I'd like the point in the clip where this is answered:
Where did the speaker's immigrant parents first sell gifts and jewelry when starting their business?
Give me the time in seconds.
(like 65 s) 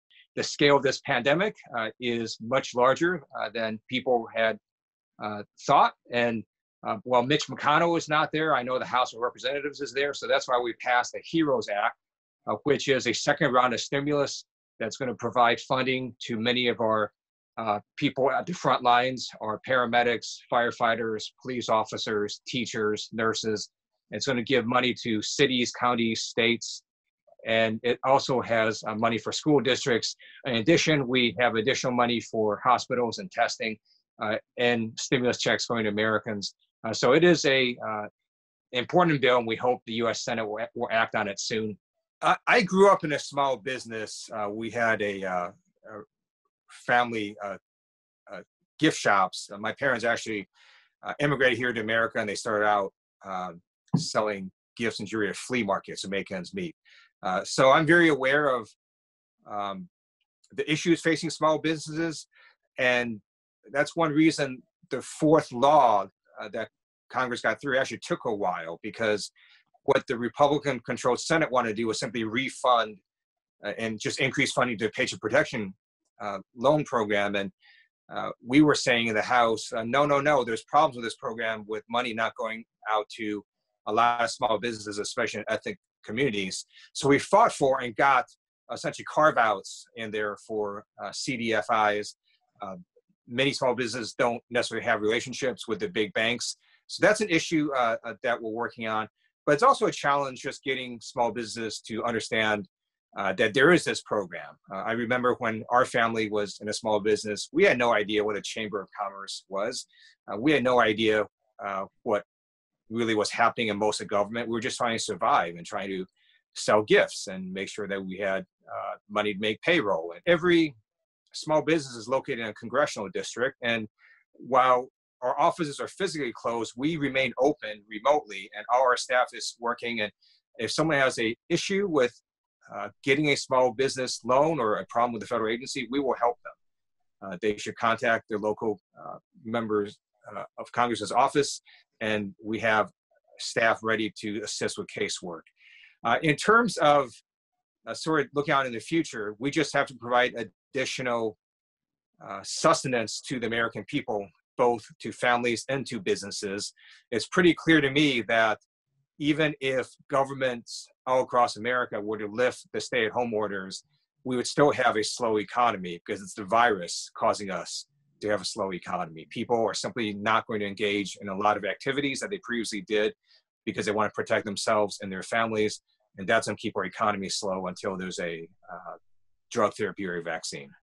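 55 s.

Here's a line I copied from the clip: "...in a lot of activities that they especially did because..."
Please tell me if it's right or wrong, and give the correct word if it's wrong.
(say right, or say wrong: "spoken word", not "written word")
wrong: "previously", not "especially".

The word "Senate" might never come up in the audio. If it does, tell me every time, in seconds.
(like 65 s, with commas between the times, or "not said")
40 s, 71 s.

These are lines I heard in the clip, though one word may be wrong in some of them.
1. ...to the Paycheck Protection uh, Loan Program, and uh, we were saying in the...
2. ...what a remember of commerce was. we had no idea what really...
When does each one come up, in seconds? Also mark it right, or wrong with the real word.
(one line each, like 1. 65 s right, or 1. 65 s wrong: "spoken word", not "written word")
1. 74 s right
2. 108 s wrong: "chamber", not "remember".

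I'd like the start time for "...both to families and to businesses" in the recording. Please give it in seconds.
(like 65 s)
154 s.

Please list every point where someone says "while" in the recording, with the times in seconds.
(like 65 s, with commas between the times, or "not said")
7 s, 68 s, 124 s.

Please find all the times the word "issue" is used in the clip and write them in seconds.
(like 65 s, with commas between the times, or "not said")
60 s, 97 s, 131 s.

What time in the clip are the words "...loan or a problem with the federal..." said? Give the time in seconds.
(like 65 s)
134 s.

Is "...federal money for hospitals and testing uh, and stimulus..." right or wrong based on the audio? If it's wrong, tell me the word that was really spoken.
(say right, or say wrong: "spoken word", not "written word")
wrong: "additional", not "federal".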